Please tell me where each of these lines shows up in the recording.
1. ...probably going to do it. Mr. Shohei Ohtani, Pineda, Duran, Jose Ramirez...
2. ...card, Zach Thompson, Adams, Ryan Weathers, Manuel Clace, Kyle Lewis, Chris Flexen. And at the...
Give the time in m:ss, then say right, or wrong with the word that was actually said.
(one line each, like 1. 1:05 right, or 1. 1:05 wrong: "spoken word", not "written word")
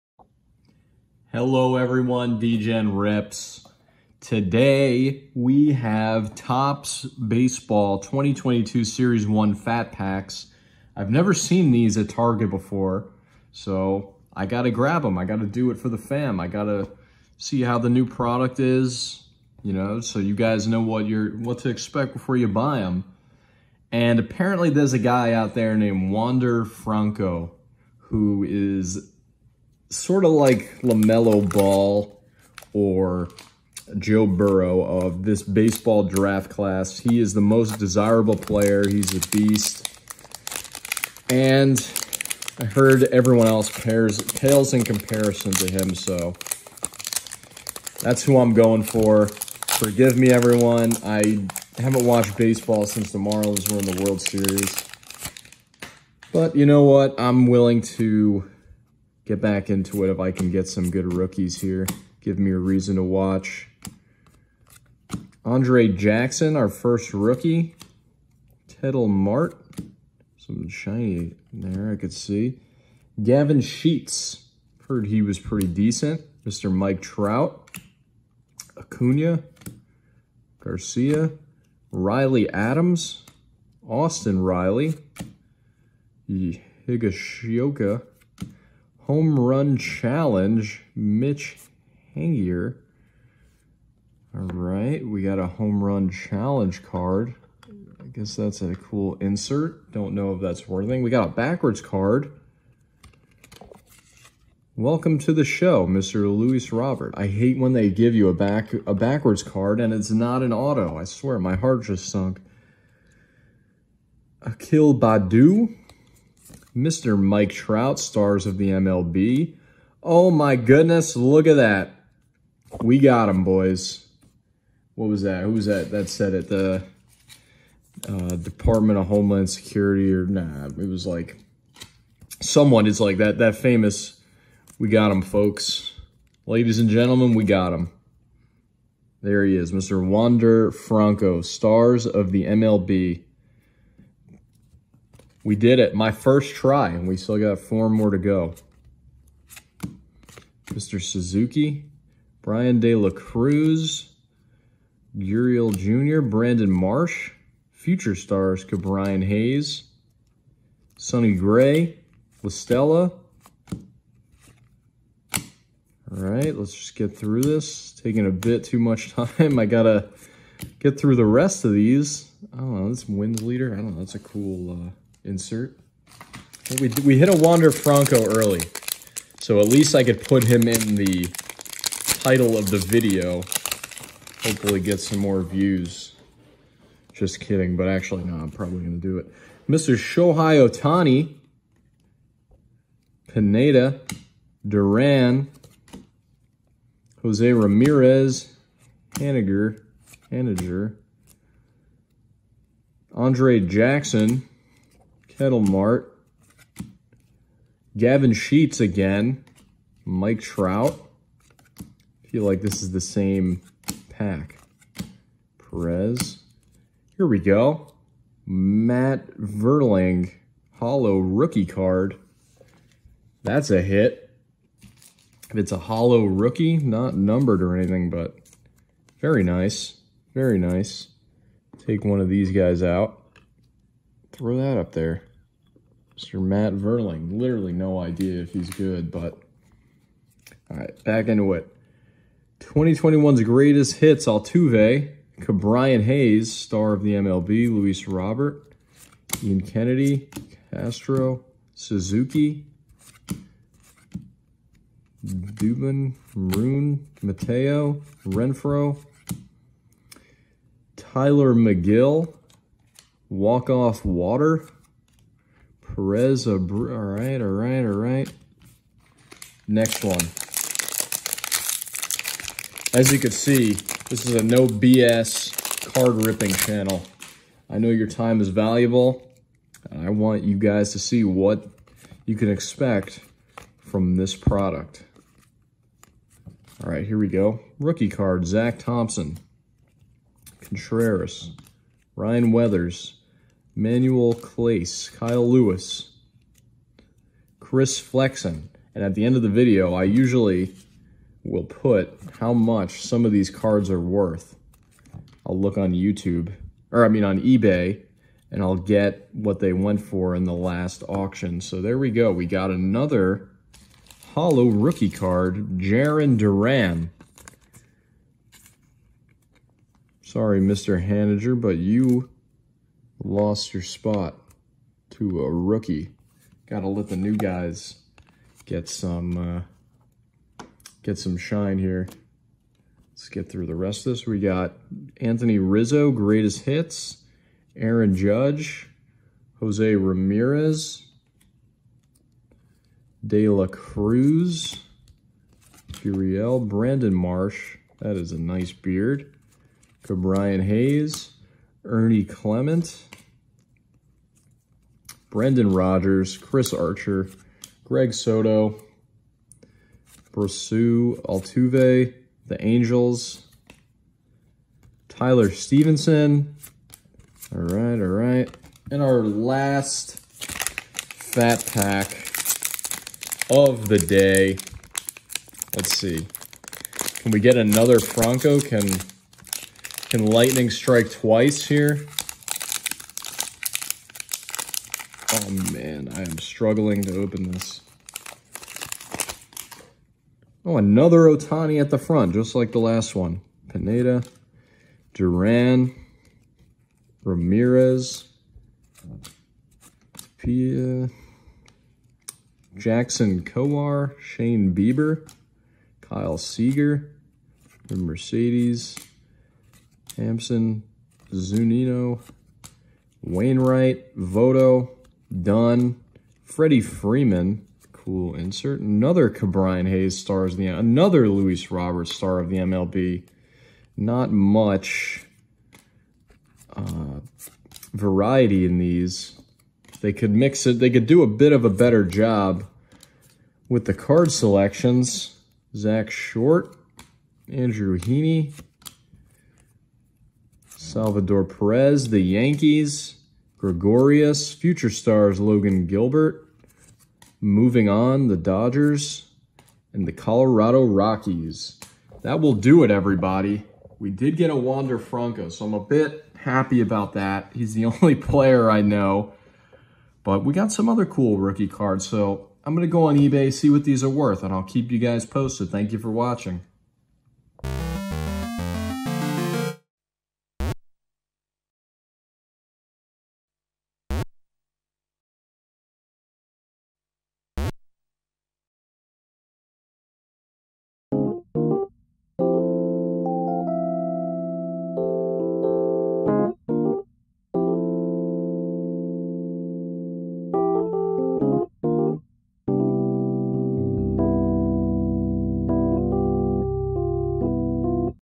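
1. 3:08 right
2. 4:48 wrong: "Contreras", not "Adams".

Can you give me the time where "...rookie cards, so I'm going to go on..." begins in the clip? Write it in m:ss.
7:41.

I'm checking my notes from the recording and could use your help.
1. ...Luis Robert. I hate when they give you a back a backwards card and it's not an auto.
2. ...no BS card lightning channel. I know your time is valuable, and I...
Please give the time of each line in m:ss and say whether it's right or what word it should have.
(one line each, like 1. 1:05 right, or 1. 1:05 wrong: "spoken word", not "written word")
1. 1:46 right
2. 4:34 wrong: "ripping", not "lightning".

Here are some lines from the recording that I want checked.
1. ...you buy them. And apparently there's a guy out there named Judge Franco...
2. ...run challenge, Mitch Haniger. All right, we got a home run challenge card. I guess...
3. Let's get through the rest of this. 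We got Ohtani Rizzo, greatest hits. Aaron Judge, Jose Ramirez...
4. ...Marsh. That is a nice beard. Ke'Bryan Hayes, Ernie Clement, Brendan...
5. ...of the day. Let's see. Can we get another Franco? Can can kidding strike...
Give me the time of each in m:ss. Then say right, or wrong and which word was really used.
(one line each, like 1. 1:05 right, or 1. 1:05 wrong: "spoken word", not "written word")
1. 0:22 wrong: "Wander", not "Judge"
2. 1:29 right
3. 5:33 wrong: "Anthony", not "Ohtani"
4. 5:47 right
5. 6:13 wrong: "lightning", not "kidding".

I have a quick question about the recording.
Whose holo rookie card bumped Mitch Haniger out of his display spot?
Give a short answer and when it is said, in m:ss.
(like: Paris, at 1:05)
Jarren Duran, at 5:15.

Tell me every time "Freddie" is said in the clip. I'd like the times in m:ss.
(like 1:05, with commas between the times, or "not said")
6:56.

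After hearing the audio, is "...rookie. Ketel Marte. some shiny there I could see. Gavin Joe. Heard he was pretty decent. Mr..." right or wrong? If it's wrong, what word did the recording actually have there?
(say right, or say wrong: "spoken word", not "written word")
wrong: "Sheets", not "Joe".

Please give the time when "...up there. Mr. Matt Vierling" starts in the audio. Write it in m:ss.
3:54.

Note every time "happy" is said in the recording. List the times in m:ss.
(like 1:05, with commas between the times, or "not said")
7:36.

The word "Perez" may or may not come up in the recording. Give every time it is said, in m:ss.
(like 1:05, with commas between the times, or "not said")
3:35, 4:26, 7:21.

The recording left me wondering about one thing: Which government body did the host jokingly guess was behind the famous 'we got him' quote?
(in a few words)
Department of Homeland Security.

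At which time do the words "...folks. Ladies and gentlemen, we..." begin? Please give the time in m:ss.
2:15.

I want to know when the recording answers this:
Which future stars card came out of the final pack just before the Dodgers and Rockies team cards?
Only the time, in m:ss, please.
7:25.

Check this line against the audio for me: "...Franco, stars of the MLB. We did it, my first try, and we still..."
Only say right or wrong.
right.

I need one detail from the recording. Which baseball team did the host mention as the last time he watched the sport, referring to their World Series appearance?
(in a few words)
Marlins.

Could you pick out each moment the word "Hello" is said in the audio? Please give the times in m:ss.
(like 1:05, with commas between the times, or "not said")
0:01.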